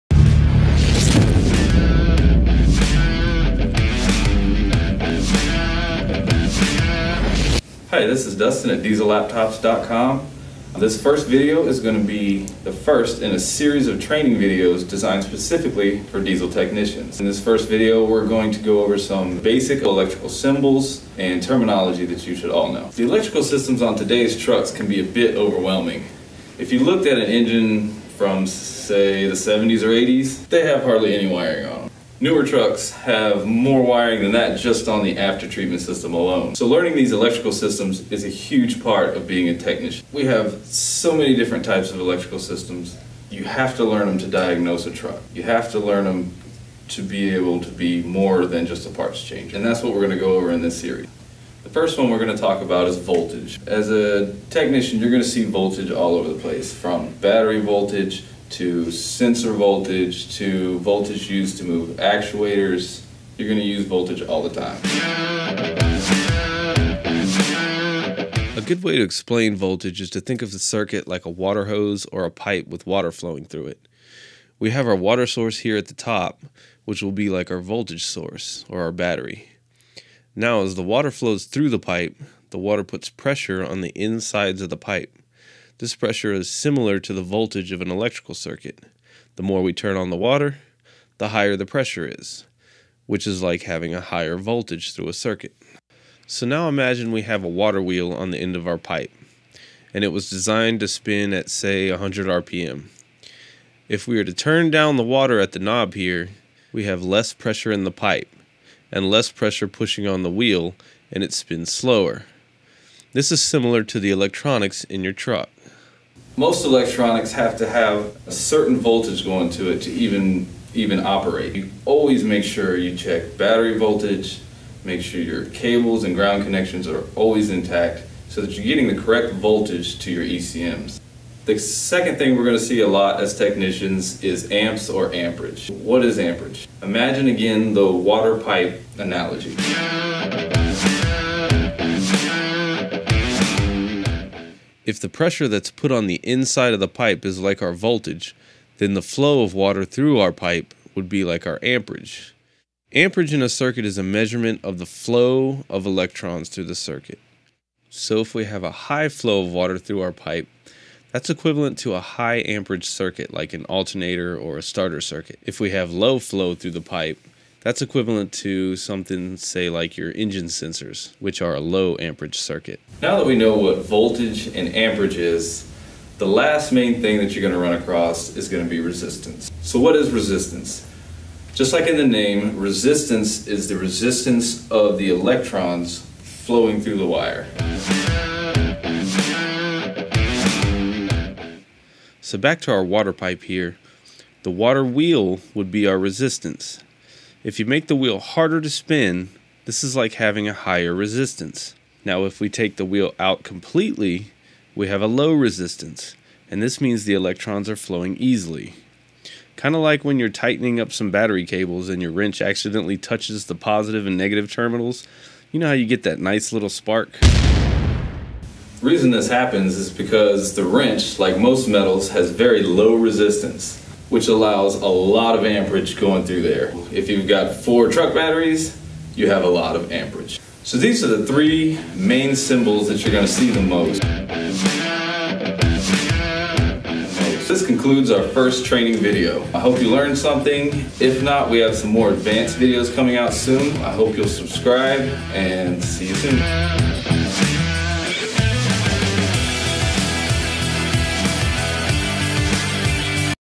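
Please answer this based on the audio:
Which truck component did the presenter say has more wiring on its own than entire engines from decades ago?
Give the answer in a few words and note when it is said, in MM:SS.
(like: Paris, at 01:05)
after treatment system, at 00:35.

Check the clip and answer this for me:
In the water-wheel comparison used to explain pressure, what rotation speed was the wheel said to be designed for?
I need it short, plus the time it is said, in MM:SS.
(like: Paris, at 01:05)
100 RPM, at 01:41.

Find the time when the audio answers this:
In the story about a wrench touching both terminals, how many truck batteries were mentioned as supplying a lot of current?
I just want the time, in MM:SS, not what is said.
03:47.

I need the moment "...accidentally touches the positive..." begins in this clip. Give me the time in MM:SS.
03:32.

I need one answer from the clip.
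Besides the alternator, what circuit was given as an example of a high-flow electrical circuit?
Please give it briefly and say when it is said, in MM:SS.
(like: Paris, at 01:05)
starter circuit, at 02:44.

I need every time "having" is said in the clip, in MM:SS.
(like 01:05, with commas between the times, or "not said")
01:33, 03:20.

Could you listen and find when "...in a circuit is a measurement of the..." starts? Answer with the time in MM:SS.
02:33.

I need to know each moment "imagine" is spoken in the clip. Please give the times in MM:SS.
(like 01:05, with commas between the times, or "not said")
01:36, 02:16.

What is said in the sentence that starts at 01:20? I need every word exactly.
Now, as the water flows through the pipe, the water puts pressure on the insides of the pipe.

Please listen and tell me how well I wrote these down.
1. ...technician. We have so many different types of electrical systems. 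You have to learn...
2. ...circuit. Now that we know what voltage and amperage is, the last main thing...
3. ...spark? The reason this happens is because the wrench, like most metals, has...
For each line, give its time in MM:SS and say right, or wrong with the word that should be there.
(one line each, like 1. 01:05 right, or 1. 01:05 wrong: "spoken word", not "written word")
1. 00:39 right
2. 02:52 right
3. 03:36 right.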